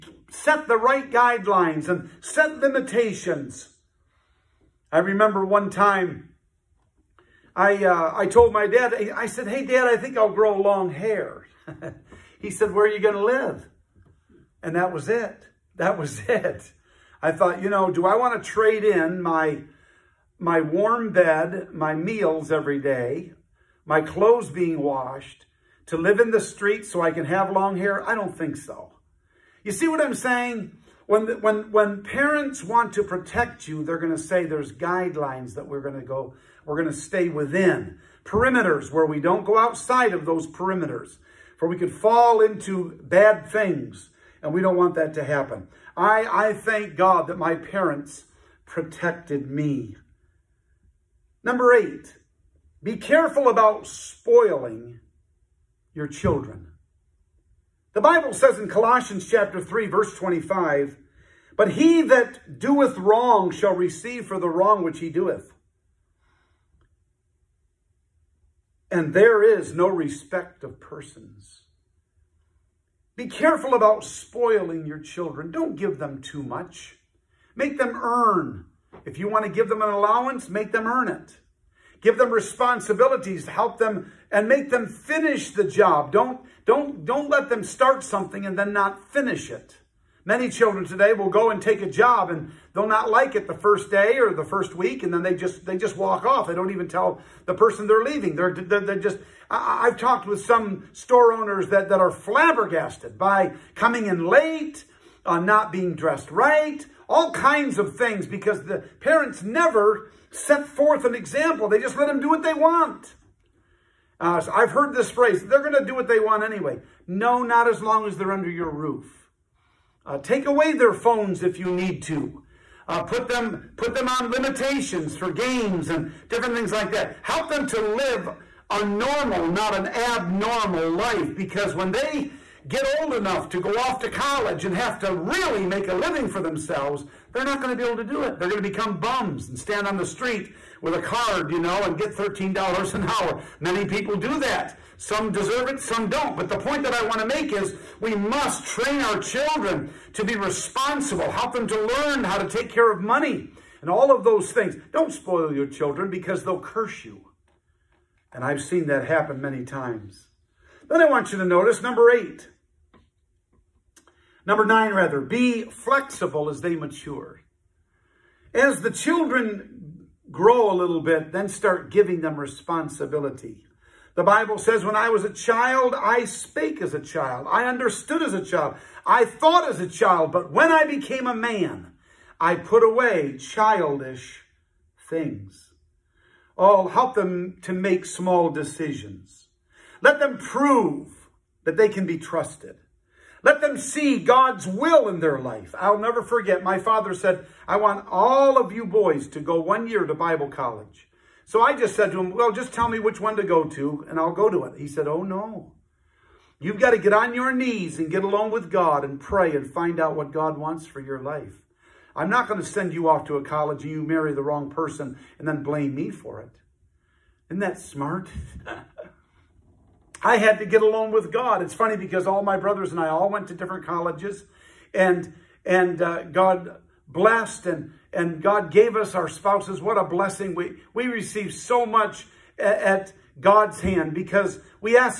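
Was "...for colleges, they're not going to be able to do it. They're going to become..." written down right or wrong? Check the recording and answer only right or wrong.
wrong.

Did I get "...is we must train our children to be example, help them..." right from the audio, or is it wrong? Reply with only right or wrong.
wrong.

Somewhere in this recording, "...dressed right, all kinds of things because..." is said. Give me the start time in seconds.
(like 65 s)
105 s.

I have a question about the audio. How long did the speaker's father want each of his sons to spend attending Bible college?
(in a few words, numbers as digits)
1 year.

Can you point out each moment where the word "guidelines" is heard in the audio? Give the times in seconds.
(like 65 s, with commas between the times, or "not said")
1 s, 34 s.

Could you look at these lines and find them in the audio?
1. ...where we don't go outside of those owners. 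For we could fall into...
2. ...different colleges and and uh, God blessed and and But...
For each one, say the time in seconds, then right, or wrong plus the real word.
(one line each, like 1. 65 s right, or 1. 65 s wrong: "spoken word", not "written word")
1. 38 s wrong: "perimeters", not "owners"
2. 223 s wrong: "God", not "But".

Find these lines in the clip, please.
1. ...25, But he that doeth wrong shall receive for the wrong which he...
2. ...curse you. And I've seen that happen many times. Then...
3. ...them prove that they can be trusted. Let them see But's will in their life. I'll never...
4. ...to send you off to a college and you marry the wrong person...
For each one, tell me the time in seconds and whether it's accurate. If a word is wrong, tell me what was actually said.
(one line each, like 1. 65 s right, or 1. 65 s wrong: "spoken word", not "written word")
1. 60 s right
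2. 156 s right
3. 190 s wrong: "God", not "But"
4. 212 s right.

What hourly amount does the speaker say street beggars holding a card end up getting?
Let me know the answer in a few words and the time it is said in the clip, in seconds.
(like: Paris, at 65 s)
$13, at 142 s.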